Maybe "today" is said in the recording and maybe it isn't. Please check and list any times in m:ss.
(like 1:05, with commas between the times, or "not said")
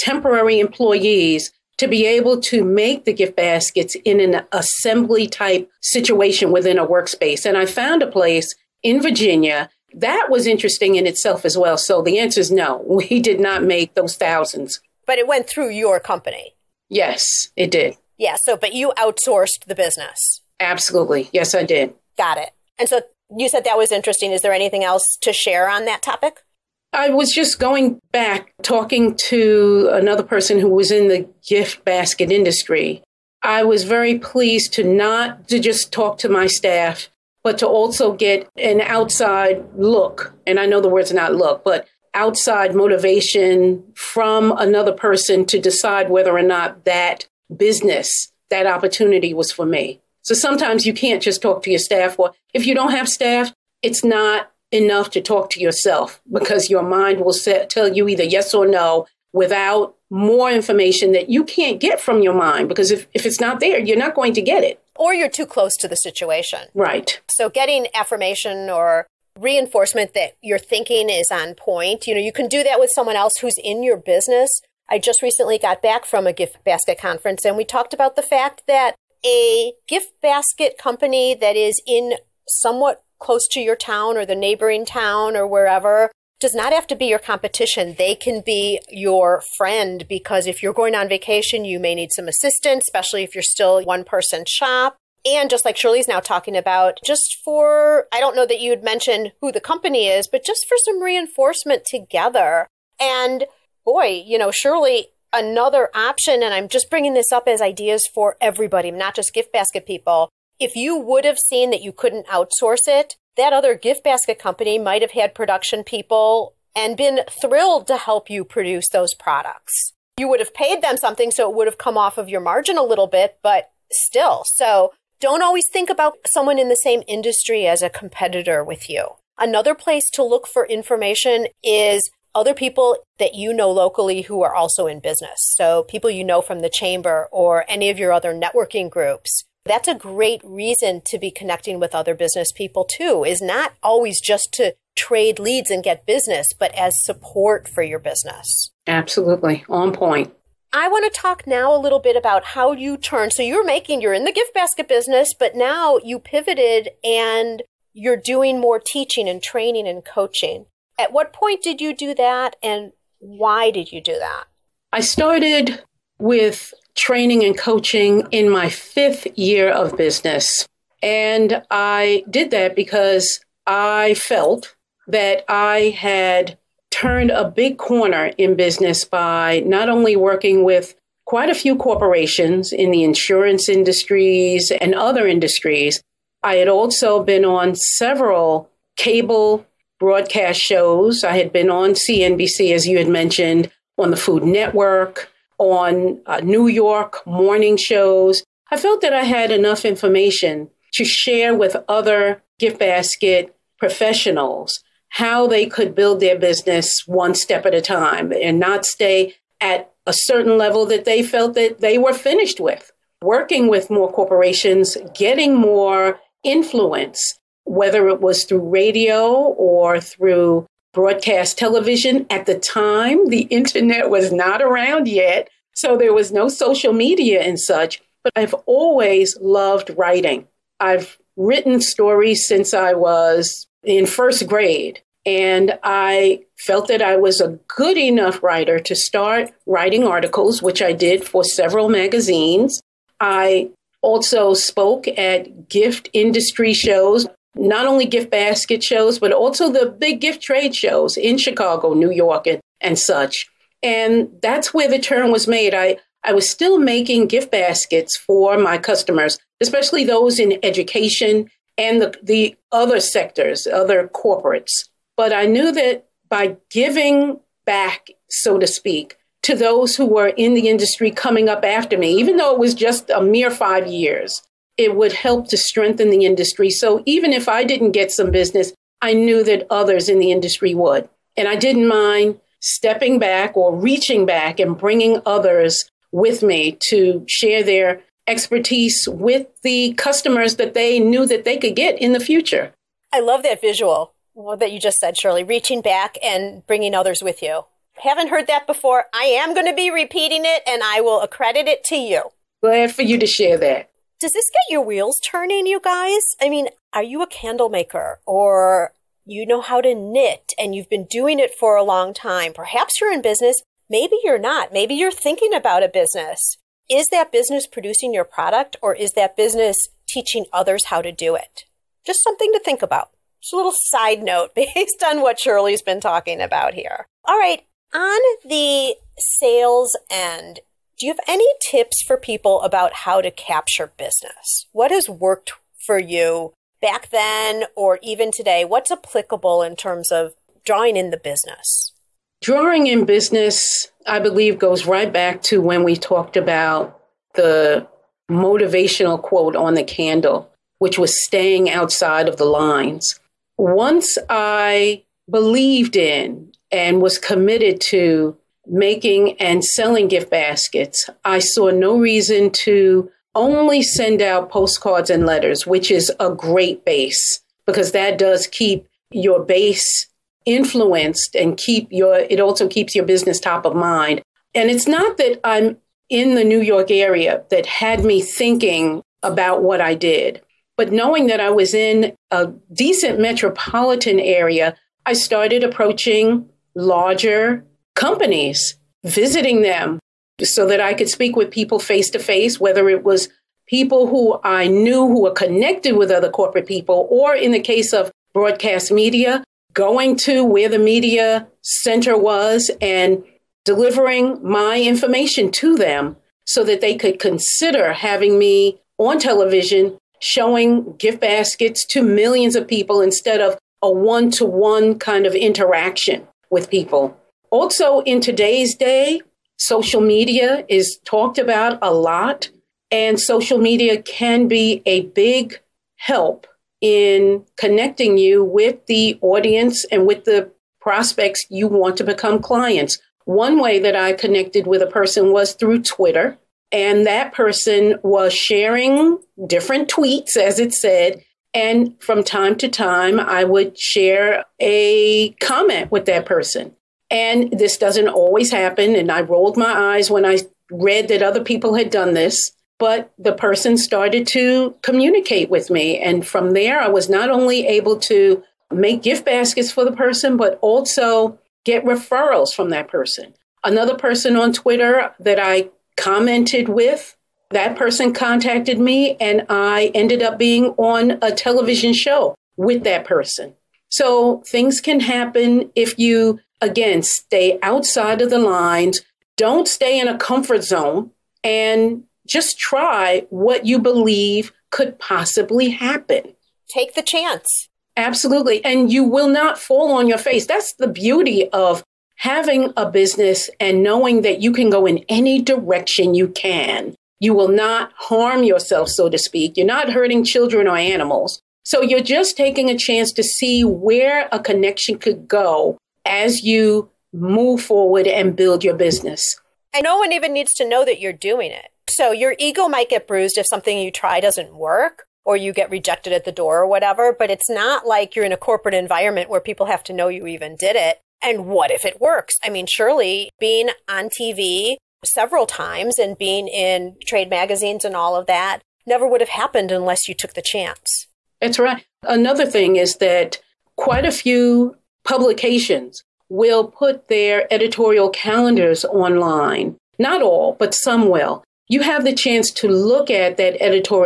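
5:38, 6:58.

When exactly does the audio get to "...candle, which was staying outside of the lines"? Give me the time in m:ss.
5:49.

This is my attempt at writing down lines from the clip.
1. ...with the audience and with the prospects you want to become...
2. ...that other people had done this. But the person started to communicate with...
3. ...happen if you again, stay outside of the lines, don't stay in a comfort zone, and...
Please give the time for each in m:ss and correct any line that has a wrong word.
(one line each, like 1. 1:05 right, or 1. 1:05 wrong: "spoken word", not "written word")
1. 7:08 right
2. 7:31 right
3. 7:54 right.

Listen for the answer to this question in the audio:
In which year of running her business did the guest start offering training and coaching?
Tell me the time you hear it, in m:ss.
2:48.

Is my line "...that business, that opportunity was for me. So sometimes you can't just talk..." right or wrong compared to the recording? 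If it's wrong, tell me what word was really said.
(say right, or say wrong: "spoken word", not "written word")
right.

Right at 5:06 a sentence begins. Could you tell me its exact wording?
I mean, are you a candle maker or you know how to knit and you've been doing it for a long time?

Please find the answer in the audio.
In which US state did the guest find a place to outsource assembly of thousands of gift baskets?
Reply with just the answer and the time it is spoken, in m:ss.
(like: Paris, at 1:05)
Virginia, at 0:09.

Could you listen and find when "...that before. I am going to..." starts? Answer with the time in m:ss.
4:58.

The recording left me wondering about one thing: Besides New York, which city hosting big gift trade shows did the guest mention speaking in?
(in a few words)
Chicago.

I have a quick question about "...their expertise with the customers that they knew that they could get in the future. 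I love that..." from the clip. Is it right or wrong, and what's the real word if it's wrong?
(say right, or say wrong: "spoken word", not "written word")
right.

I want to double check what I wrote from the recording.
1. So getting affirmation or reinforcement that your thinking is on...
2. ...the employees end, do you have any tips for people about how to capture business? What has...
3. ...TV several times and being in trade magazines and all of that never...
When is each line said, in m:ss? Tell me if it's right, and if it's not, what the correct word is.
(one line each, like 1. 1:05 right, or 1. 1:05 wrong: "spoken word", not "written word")
1. 1:07 right
2. 5:28 wrong: "sales", not "employees"
3. 8:44 right.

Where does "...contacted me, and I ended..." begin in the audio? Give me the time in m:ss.
7:48.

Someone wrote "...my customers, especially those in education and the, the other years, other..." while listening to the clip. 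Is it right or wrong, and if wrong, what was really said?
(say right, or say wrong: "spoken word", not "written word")
wrong: "sectors", not "years".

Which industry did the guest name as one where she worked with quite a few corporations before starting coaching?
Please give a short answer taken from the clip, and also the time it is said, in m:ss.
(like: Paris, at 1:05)
Insurance, at 3:03.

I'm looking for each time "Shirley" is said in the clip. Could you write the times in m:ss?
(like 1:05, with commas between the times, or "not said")
1:35, 1:44, 4:55, 5:25.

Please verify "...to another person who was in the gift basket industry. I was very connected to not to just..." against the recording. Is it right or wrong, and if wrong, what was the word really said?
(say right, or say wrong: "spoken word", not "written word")
wrong: "pleased", not "connected".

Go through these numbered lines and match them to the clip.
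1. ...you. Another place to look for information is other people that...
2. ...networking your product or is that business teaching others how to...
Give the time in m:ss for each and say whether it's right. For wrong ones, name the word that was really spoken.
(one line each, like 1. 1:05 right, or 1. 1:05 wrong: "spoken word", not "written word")
1. 2:08 right
2. 5:17 wrong: "producing", not "networking".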